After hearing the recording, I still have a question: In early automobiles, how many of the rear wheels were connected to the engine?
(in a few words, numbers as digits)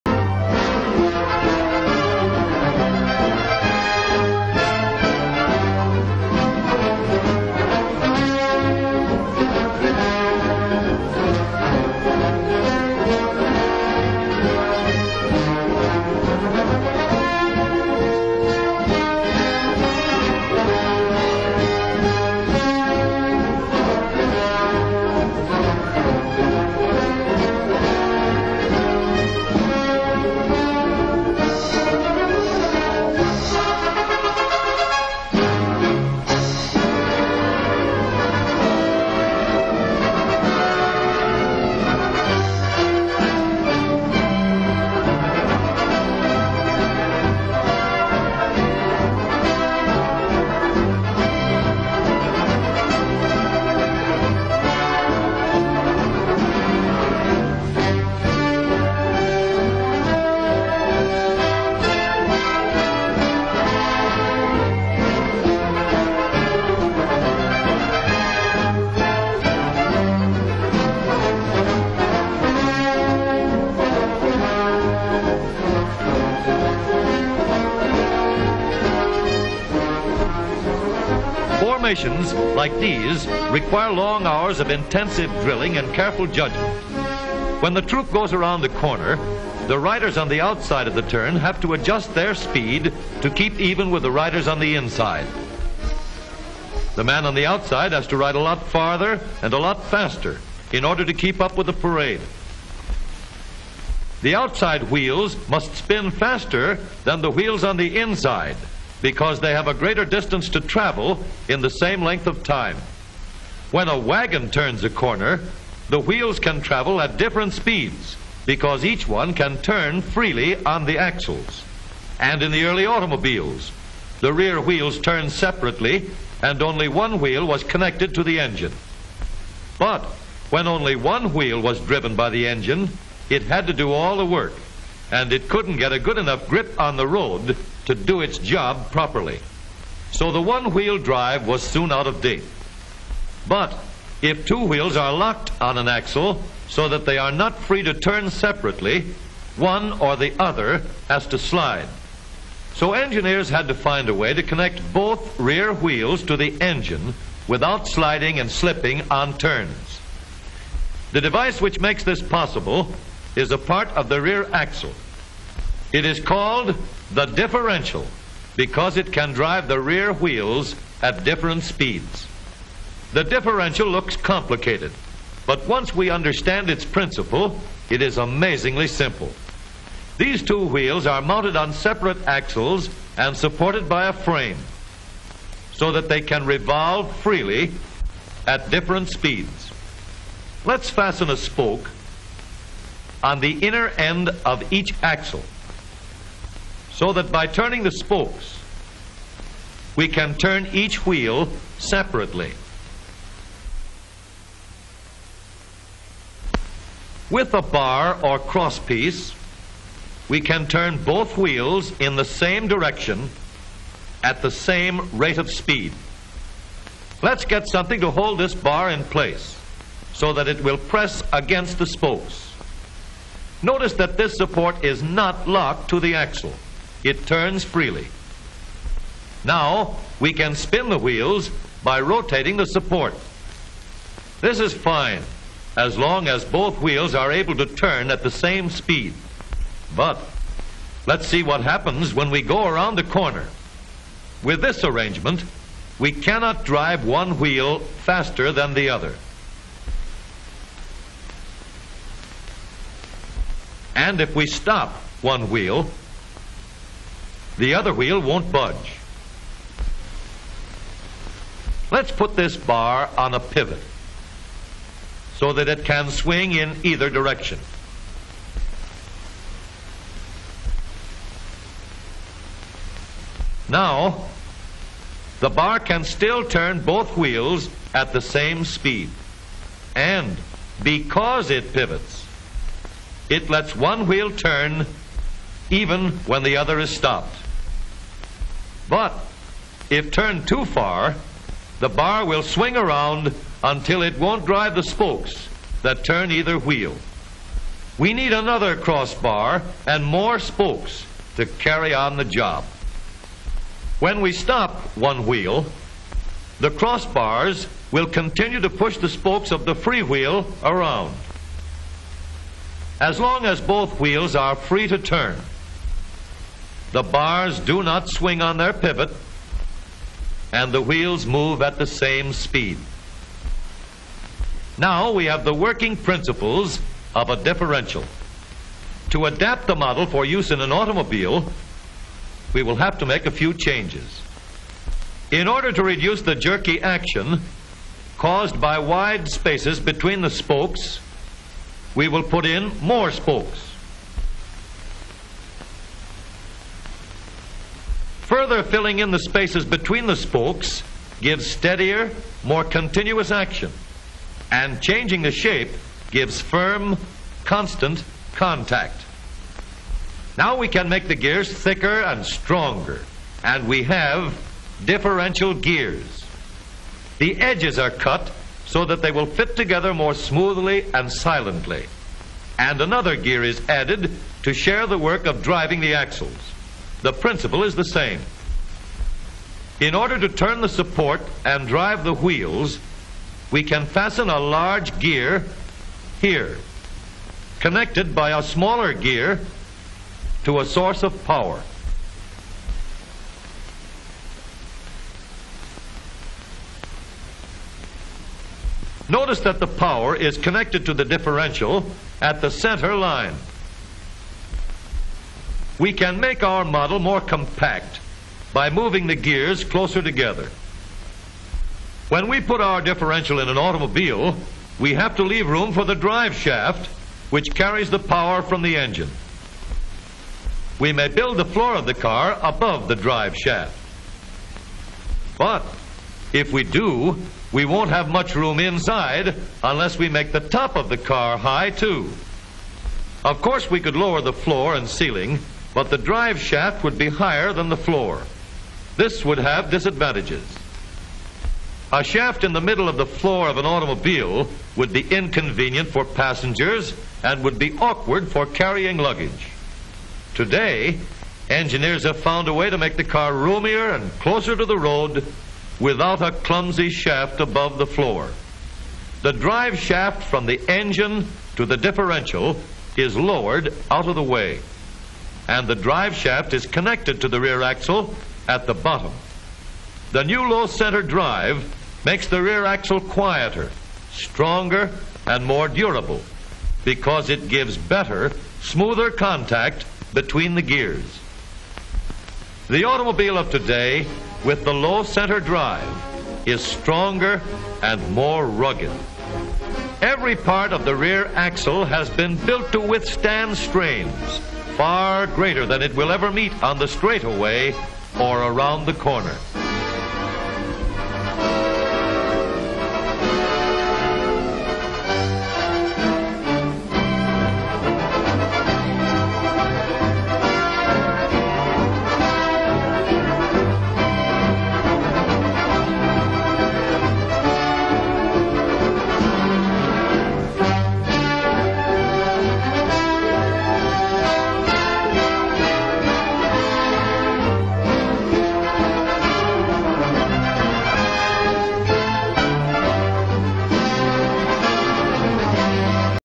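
1.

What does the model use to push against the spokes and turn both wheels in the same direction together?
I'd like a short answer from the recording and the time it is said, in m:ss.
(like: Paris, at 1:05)
a bar or crosspiece, at 3:27.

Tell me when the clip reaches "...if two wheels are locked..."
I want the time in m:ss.
2:24.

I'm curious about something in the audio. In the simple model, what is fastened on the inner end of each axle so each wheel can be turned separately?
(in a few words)
a spoke.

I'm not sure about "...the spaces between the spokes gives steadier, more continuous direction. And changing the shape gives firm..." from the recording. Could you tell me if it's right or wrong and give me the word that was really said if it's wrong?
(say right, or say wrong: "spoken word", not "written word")
wrong: "action", not "direction".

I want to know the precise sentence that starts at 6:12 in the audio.
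And another gear is added to share the work of driving the axles.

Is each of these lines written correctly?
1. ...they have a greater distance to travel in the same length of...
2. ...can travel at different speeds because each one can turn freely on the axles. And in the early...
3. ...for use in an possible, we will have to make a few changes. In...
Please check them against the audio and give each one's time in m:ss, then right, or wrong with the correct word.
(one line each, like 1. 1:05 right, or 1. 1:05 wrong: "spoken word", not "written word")
1. 1:49 right
2. 1:56 right
3. 5:30 wrong: "automobile", not "possible".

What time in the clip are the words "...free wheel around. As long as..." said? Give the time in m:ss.
5:09.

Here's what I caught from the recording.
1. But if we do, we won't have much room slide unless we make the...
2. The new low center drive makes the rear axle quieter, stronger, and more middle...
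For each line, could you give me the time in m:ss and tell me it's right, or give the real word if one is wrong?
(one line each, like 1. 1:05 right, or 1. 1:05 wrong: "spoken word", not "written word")
1. 7:05 wrong: "inside", not "slide"
2. 7:50 wrong: "durable", not "middle".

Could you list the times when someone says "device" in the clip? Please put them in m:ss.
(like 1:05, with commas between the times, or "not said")
2:41.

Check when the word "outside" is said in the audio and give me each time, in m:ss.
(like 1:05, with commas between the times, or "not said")
1:30, 1:37, 1:44.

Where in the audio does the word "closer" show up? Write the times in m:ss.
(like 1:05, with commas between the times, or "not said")
6:49, 7:34.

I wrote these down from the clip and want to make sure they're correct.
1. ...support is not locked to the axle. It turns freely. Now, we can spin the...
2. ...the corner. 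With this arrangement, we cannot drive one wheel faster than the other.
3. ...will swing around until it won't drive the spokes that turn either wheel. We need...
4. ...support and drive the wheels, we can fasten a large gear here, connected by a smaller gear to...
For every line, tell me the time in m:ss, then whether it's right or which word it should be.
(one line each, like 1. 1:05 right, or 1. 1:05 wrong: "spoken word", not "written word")
1. 3:44 right
2. 4:02 right
3. 4:52 right
4. 6:20 right.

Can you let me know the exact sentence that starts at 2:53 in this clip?
The differential looks complicated, but once we understand its principle, it is amazingly simple.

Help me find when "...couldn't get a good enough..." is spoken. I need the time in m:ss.
2:15.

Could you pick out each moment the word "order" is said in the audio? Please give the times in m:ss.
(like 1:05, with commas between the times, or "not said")
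1:40, 5:35, 6:19.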